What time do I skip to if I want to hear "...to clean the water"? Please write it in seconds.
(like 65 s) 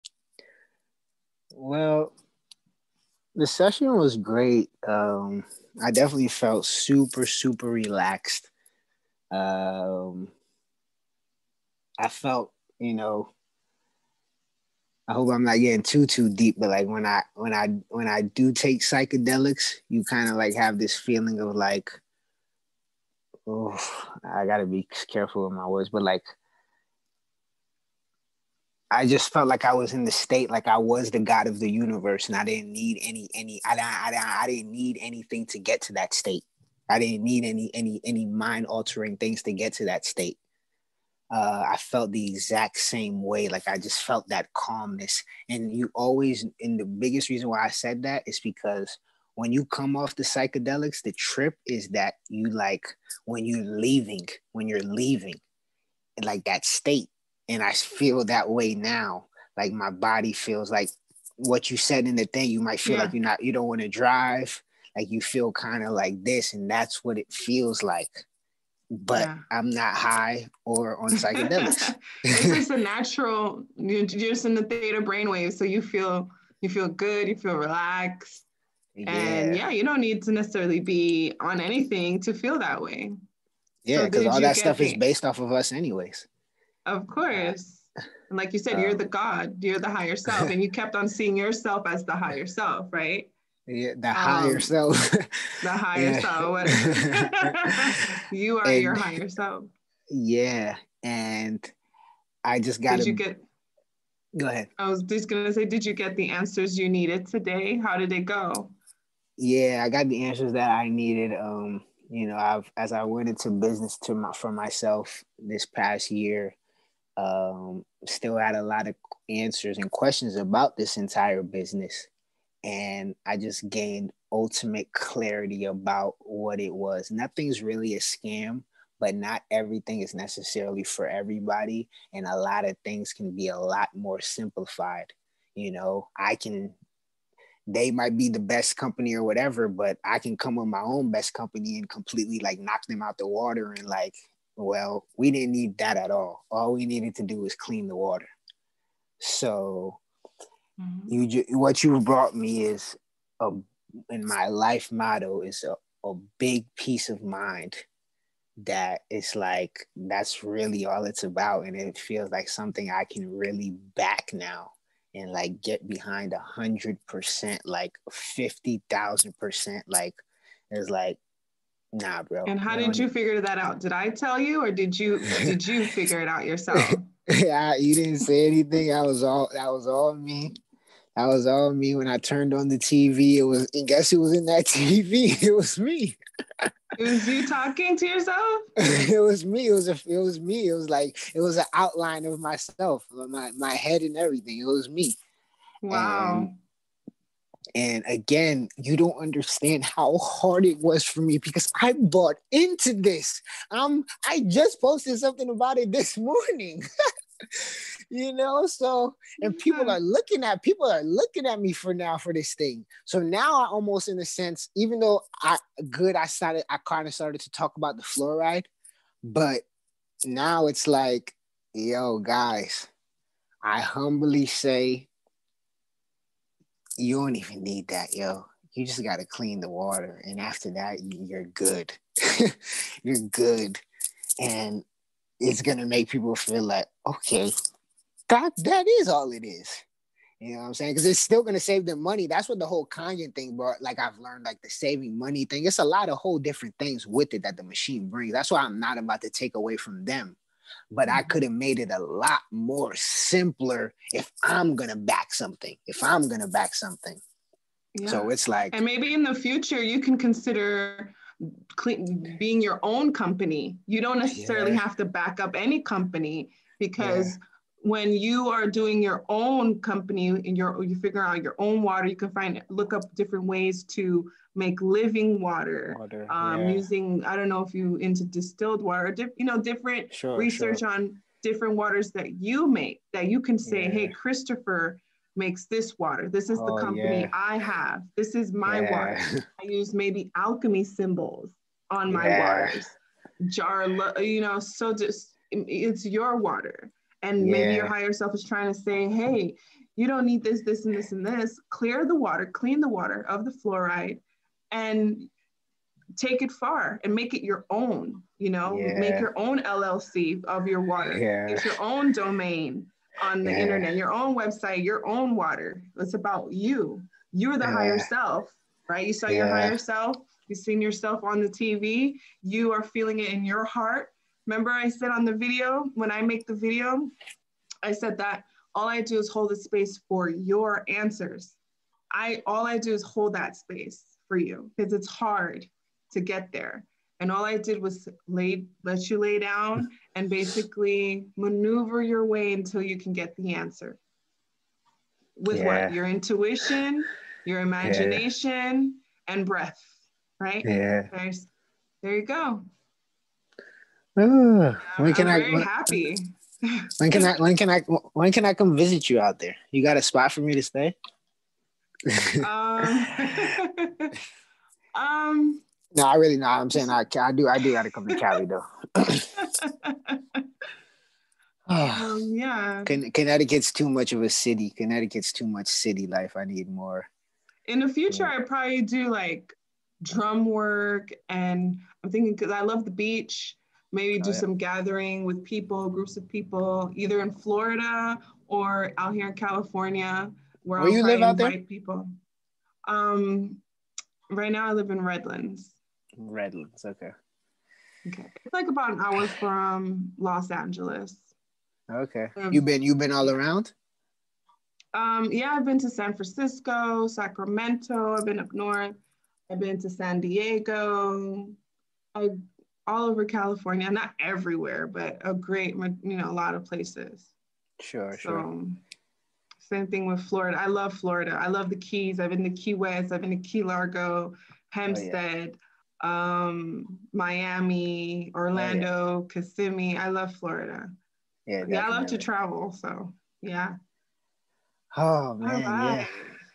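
229 s.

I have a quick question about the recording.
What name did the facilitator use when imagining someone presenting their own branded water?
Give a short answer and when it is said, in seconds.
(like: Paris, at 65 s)
Christopher, at 284 s.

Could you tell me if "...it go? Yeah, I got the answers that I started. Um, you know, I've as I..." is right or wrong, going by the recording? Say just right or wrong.
wrong.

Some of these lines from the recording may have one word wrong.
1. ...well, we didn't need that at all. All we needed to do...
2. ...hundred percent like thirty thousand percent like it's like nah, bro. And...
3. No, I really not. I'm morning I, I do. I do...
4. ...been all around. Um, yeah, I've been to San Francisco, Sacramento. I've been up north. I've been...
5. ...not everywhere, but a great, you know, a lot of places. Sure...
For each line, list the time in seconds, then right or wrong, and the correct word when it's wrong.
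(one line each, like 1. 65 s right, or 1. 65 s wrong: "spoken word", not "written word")
1. 144 s right
2. 166 s wrong: "fifty", not "thirty"
3. 365 s wrong: "saying", not "morning"
4. 402 s right
5. 413 s right.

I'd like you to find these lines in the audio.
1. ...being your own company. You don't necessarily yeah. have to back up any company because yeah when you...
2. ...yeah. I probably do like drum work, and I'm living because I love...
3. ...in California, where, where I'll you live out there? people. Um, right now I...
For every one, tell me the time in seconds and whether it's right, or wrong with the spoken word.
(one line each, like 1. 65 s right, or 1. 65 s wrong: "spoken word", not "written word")
1. 262 s right
2. 378 s wrong: "thinking", not "living"
3. 389 s right.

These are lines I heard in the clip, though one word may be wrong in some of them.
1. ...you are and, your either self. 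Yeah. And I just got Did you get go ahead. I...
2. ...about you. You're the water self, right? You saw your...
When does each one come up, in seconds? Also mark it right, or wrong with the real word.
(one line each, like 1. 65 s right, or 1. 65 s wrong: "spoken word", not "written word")
1. 98 s wrong: "higher", not "either"
2. 316 s wrong: "higher", not "water".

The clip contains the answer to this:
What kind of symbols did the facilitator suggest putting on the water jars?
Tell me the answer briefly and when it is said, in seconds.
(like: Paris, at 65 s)
alchemy symbols, at 290 s.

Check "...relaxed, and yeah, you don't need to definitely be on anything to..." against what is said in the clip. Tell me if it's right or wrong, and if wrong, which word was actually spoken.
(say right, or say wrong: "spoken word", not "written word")
wrong: "necessarily", not "definitely".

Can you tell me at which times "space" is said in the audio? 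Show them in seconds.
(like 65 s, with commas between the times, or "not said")
329 s, 333 s.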